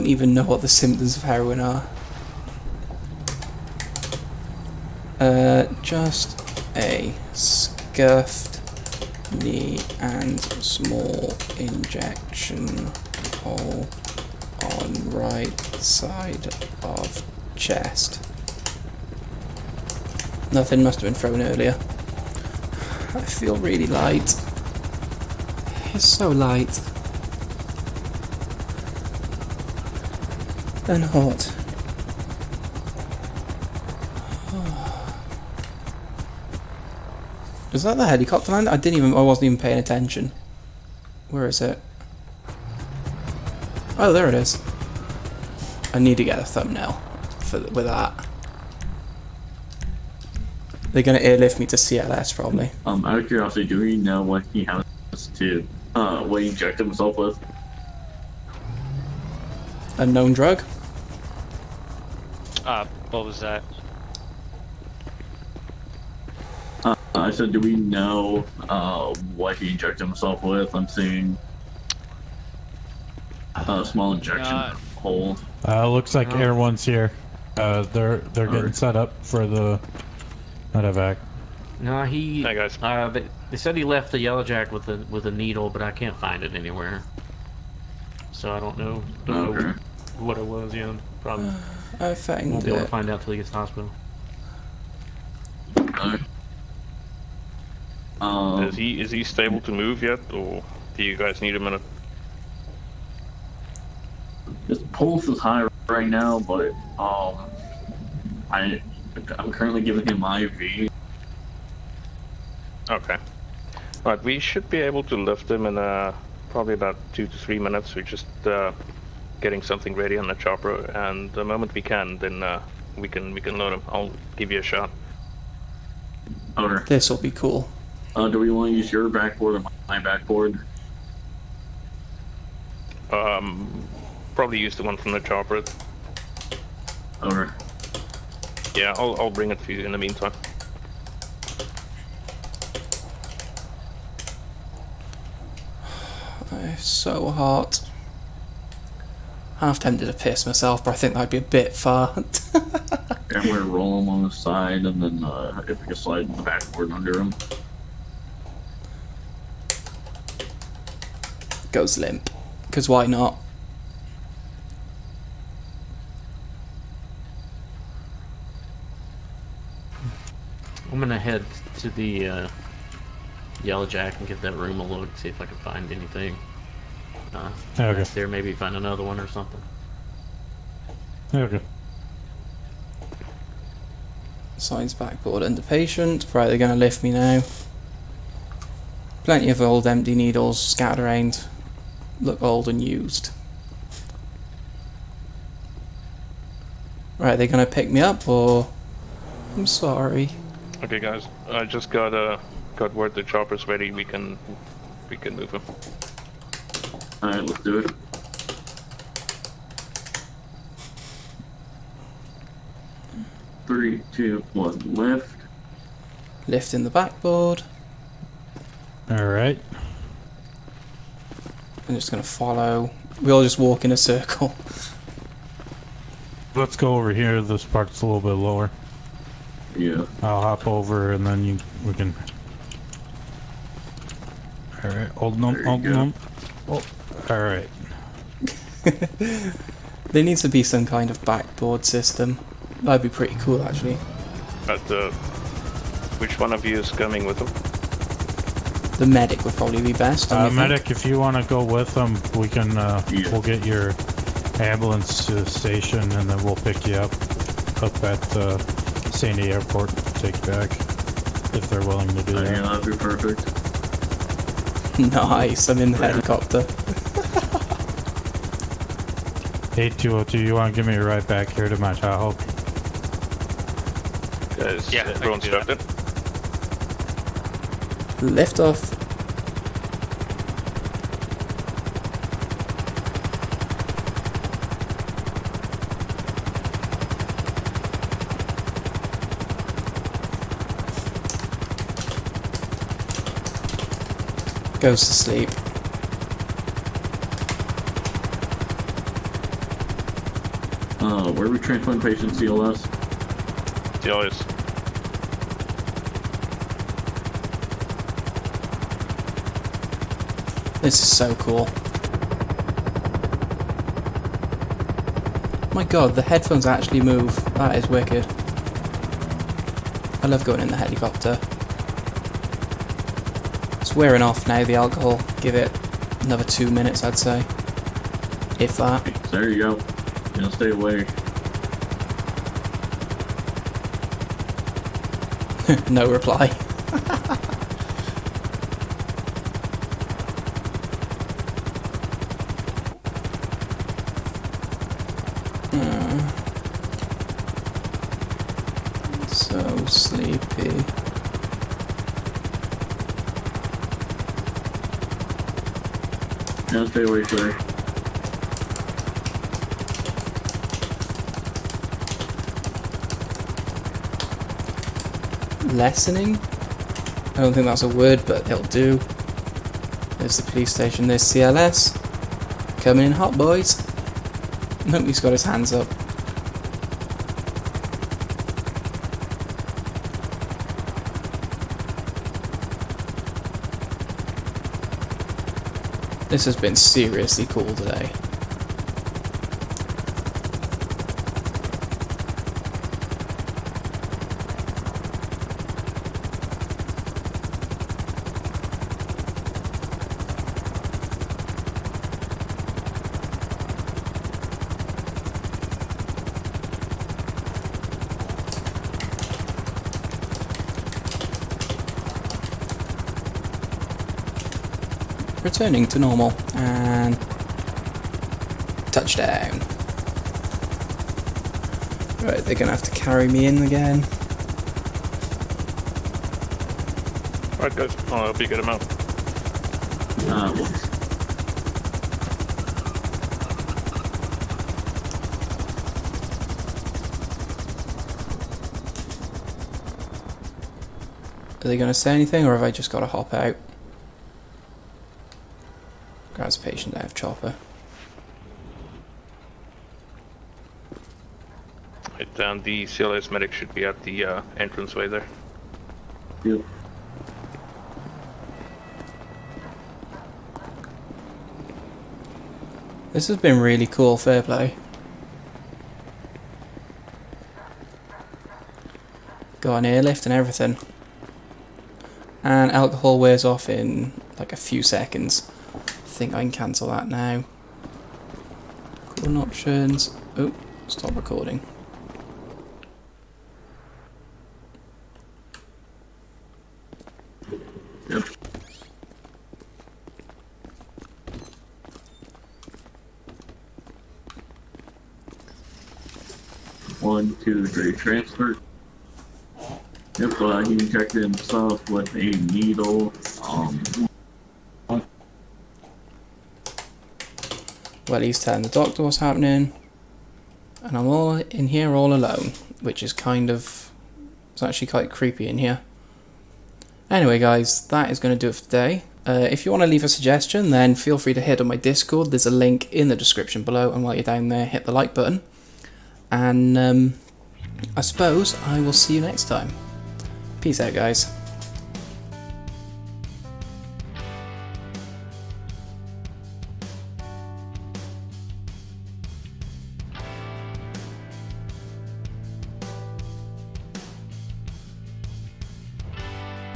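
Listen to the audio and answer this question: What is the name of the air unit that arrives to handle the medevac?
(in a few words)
Air One.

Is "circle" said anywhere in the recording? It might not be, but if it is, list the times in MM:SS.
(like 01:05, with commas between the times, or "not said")
03:43.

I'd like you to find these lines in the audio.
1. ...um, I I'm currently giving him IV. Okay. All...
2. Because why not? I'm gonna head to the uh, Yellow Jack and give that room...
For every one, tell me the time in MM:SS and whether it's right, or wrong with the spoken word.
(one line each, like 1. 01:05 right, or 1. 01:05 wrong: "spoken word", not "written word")
1. 01:46 right
2. 02:42 right.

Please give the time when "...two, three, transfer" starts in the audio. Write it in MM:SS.
08:17.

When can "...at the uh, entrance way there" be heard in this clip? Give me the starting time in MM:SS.
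07:33.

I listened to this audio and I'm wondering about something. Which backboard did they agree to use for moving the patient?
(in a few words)
the one from the chopper.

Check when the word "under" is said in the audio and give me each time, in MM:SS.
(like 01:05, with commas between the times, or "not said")
02:36, 03:05.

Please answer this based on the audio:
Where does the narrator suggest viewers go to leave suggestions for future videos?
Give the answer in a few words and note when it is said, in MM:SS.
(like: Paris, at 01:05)
Discord, at 08:41.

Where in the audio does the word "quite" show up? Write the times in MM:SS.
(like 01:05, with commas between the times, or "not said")
08:34.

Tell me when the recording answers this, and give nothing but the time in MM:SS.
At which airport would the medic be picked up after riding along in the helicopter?
04:19.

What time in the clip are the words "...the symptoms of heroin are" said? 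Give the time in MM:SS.
00:00.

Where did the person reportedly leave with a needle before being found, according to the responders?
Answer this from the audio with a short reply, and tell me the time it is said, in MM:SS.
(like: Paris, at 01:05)
the Yellow Jack, at 01:24.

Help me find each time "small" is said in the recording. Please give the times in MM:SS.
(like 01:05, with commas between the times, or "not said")
00:10, 01:13.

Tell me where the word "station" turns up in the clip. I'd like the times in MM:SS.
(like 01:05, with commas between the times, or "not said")
04:15, 06:10.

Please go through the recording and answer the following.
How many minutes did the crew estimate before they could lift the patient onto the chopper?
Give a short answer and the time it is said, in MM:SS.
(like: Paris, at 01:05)
2 to 3 minutes, at 01:57.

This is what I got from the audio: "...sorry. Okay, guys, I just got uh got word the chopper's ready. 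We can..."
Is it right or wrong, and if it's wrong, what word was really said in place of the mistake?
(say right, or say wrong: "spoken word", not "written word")
right.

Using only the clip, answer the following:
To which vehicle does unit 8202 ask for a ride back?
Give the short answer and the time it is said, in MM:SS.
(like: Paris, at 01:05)
Tahoe, at 04:31.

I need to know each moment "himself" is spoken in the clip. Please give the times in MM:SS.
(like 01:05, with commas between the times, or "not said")
00:56, 01:10.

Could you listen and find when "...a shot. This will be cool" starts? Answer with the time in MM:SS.
02:04.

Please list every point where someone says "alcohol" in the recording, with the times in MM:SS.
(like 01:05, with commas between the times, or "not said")
05:24, 07:52.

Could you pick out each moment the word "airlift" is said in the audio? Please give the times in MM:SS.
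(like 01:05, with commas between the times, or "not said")
00:51, 07:49.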